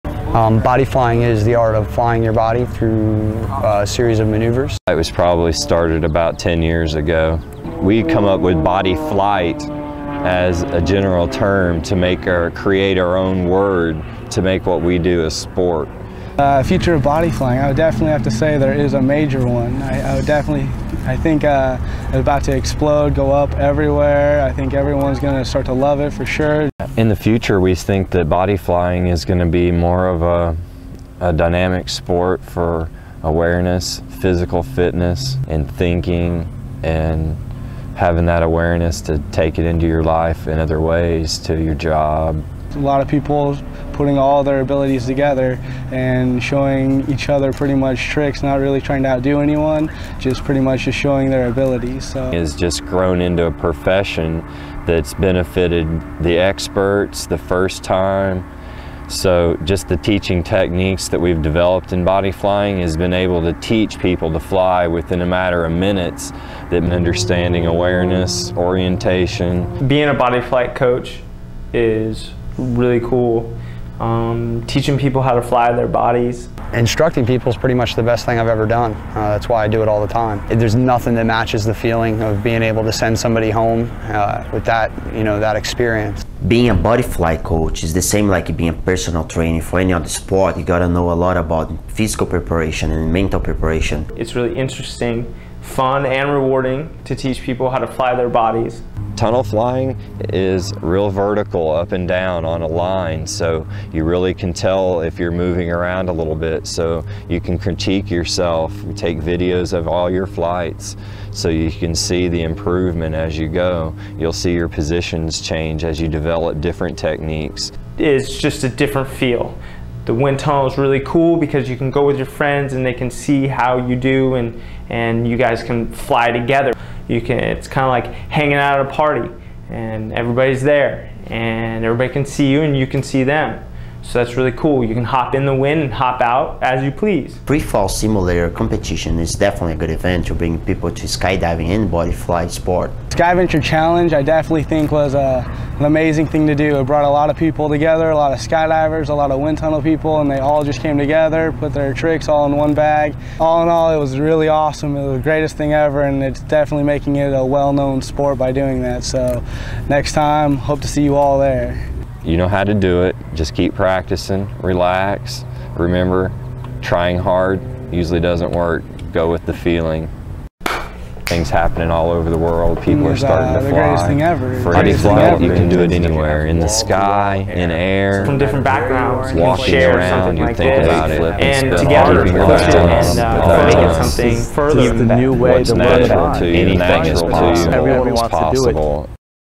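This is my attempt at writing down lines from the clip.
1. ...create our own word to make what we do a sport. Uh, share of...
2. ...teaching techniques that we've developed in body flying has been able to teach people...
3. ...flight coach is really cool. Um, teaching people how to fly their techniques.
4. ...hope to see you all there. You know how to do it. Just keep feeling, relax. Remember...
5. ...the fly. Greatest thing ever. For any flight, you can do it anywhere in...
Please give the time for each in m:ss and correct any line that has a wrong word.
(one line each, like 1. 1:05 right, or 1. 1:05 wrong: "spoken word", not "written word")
1. 0:12 wrong: "future", not "share"
2. 0:59 right
3. 1:10 wrong: "bodies", not "techniques"
4. 2:40 wrong: "practicing", not "feeling"
5. 2:53 right.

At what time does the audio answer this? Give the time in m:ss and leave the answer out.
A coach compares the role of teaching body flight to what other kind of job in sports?
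1:28.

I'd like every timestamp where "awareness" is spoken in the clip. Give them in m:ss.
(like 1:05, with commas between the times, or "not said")
0:33, 0:38, 1:07.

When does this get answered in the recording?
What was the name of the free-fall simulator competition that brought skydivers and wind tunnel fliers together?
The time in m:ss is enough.
2:23.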